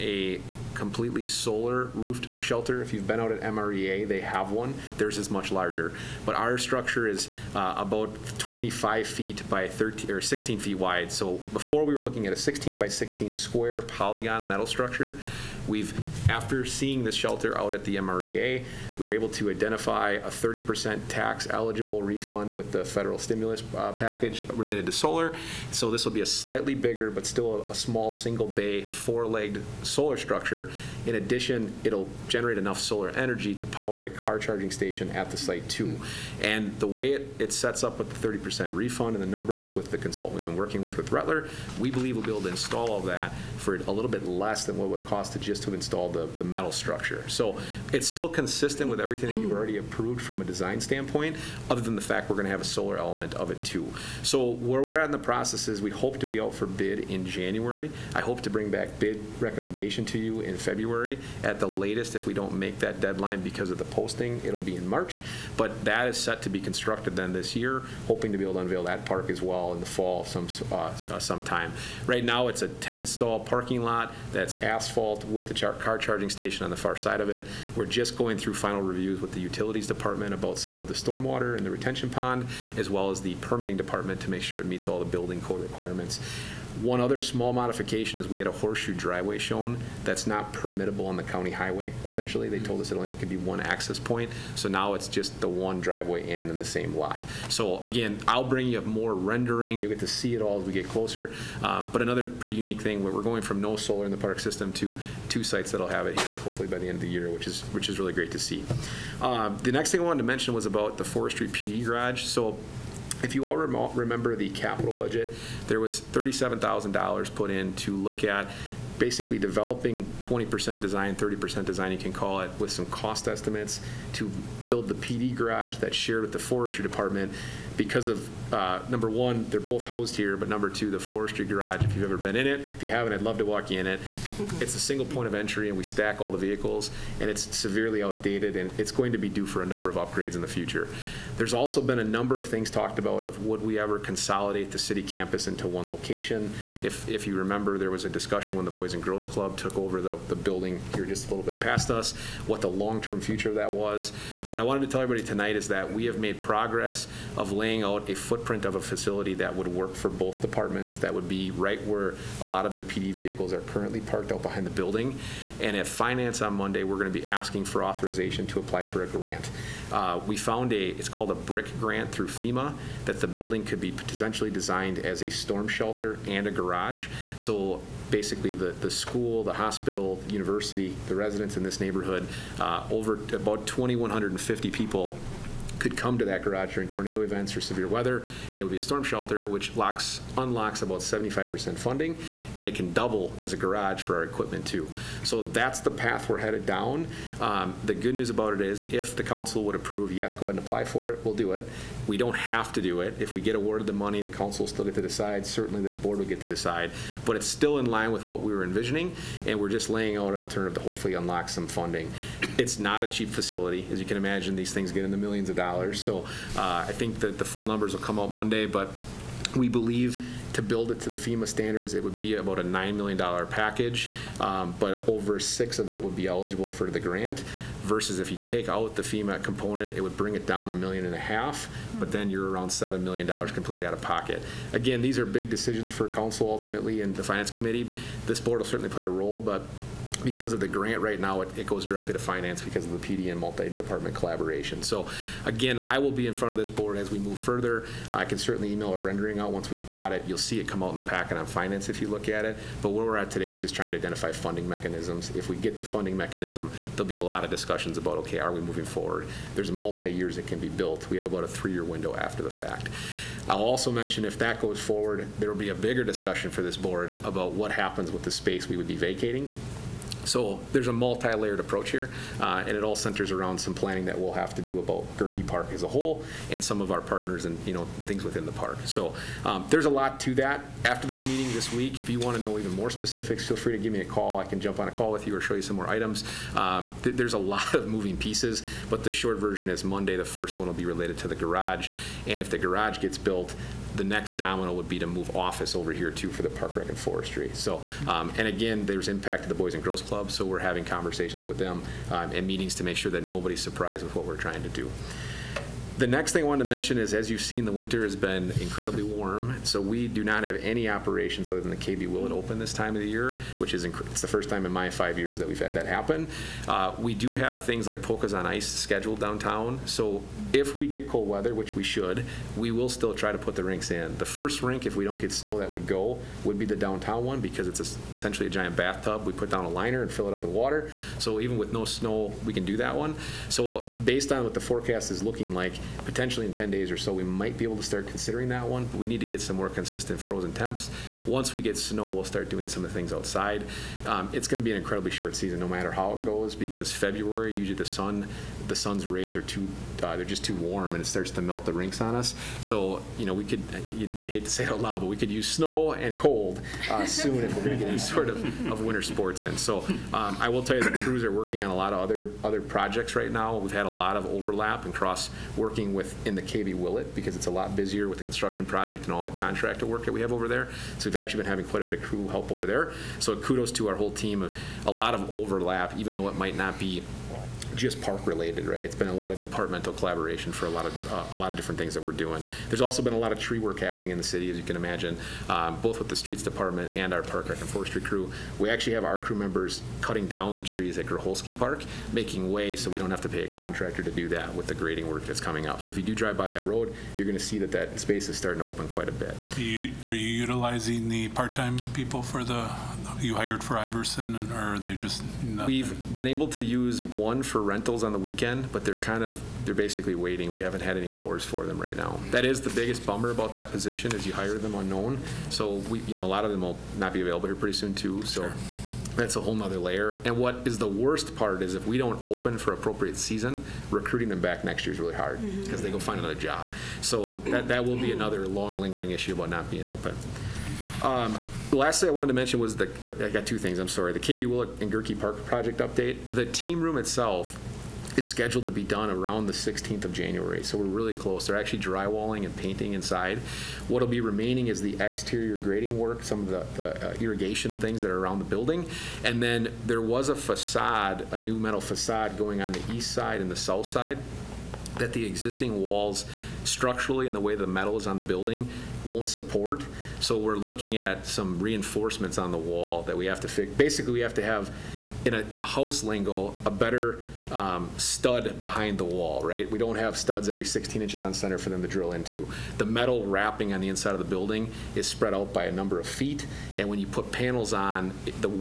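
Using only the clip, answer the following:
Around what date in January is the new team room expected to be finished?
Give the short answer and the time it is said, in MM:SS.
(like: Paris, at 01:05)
January 16, at 07:19.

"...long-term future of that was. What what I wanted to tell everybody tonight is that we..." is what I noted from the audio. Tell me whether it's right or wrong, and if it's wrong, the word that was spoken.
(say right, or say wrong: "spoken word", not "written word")
right.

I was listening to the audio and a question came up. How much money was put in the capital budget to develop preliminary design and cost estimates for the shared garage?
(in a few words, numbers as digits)
$37,000.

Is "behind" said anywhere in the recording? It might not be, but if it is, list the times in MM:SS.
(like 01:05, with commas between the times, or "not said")
02:44, 07:48.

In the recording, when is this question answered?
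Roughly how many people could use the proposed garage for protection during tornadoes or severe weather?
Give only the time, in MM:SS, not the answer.
03:03.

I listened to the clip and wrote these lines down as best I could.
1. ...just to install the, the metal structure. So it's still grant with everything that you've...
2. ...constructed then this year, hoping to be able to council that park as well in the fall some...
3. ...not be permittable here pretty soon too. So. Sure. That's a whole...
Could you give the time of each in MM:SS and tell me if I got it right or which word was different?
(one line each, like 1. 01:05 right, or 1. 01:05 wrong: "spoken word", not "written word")
1. 00:45 wrong: "consistent", not "grant"
2. 01:06 wrong: "unveil", not "council"
3. 06:56 wrong: "available", not "permittable".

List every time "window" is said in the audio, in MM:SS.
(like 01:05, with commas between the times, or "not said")
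04:21.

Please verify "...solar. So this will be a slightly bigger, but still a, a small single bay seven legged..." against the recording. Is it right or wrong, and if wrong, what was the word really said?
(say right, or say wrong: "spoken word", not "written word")
wrong: "four", not "seven".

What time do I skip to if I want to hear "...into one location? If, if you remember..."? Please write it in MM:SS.
02:25.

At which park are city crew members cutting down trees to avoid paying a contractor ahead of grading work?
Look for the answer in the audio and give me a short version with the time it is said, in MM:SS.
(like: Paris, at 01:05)
Groholski Park, at 06:31.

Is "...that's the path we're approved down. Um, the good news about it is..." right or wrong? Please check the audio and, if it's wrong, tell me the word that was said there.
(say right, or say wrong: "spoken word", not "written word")
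wrong: "headed", not "approved".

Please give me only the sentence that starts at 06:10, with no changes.
So we've actually been having quite a bit of crew help over there.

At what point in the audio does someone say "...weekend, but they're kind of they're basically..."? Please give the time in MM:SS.
06:48.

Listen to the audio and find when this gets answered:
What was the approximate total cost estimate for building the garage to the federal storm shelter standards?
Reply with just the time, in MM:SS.
03:42.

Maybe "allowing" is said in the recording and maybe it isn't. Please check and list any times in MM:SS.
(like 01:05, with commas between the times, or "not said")
not said.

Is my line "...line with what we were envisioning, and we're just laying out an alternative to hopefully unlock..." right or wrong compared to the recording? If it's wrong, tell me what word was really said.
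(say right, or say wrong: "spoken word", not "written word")
right.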